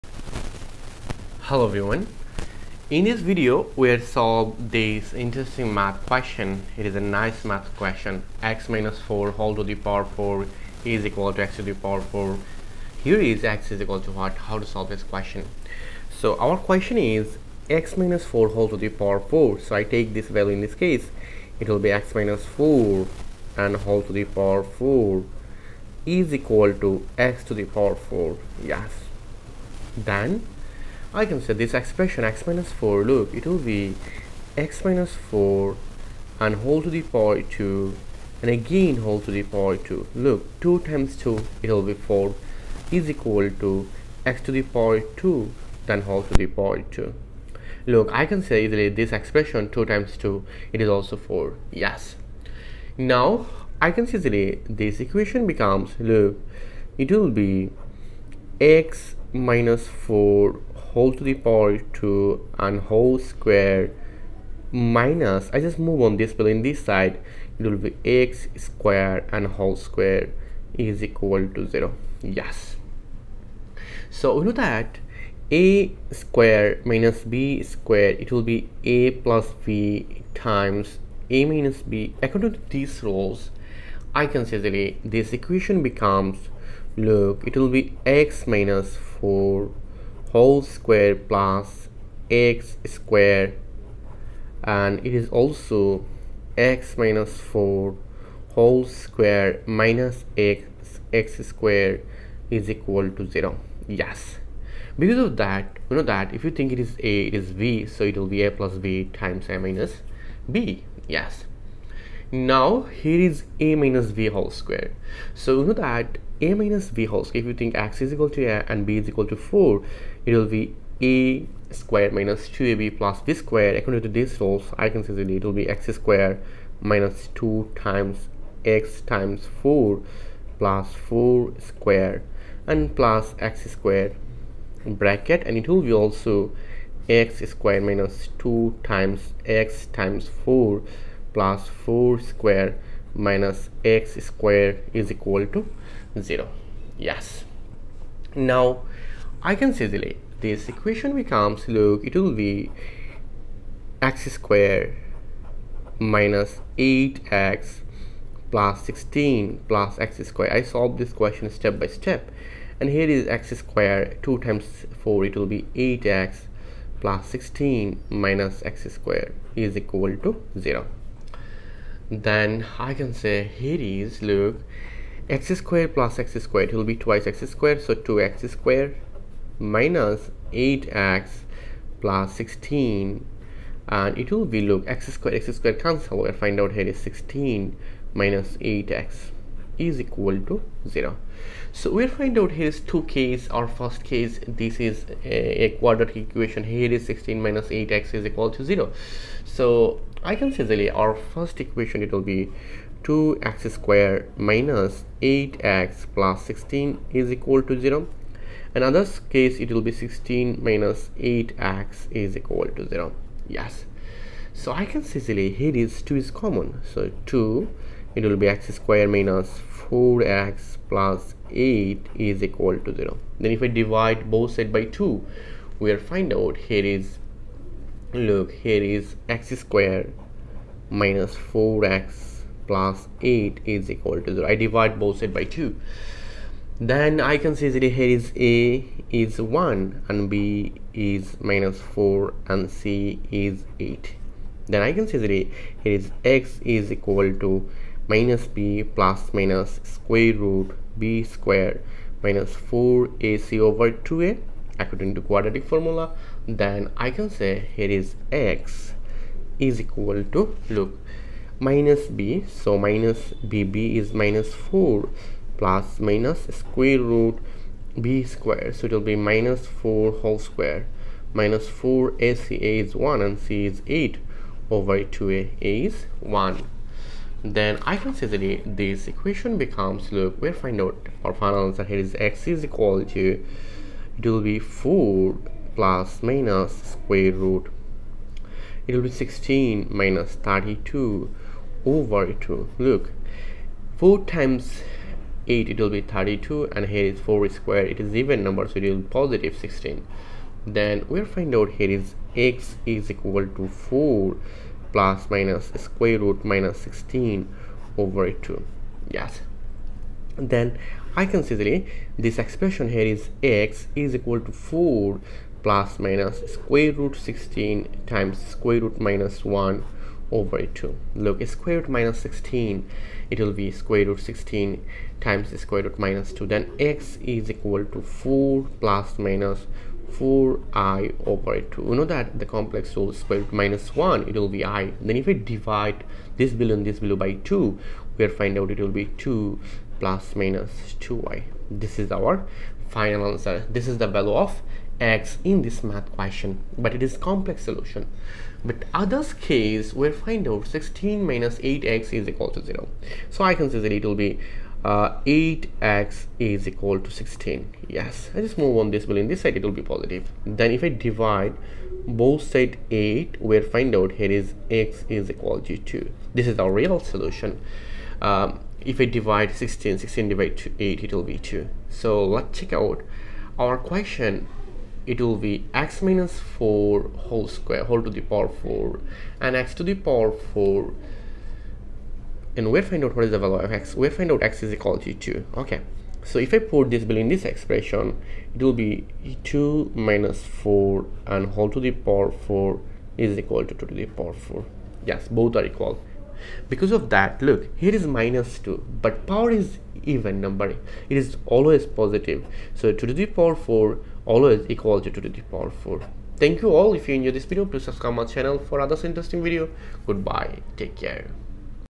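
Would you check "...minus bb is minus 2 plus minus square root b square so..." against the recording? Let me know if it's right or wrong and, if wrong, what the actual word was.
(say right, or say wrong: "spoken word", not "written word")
wrong: "4", not "2".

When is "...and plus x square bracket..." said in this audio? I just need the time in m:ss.
2:12.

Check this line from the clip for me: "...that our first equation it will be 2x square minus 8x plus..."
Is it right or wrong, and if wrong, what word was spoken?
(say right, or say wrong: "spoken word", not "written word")
right.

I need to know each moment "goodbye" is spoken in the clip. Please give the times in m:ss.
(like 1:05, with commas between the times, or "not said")
6:50.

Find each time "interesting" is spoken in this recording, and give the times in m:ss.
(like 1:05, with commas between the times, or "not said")
0:05, 6:49.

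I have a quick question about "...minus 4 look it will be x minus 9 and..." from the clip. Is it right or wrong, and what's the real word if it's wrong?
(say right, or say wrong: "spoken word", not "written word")
wrong: "4", not "9".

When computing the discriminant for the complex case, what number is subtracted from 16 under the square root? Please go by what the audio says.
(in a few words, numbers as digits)
32.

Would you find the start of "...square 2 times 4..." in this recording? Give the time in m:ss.
2:43.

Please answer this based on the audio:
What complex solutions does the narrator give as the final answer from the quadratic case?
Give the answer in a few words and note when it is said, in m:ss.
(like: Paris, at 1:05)
2 ± 2i, at 5:39.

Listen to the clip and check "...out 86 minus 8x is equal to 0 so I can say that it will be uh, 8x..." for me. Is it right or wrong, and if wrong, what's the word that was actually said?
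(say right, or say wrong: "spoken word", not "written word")
wrong: "16", not "86".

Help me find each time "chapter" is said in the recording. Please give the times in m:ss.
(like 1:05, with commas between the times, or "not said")
not said.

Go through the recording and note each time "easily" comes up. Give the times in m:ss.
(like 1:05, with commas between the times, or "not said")
0:48, 0:54, 2:29, 3:35.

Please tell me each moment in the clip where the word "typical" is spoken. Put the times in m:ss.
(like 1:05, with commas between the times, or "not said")
not said.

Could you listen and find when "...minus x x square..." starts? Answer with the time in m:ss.
1:39.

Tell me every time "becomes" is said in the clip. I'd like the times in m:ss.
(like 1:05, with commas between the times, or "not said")
0:55, 1:25, 2:31, 4:39.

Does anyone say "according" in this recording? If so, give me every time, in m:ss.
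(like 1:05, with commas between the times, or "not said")
1:22, 2:03, 4:14.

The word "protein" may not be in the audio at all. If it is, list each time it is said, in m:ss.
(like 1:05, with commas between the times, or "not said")
not said.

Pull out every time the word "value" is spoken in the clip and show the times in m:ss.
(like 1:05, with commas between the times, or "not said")
0:20, 5:44, 6:23.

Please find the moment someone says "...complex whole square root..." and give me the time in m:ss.
5:32.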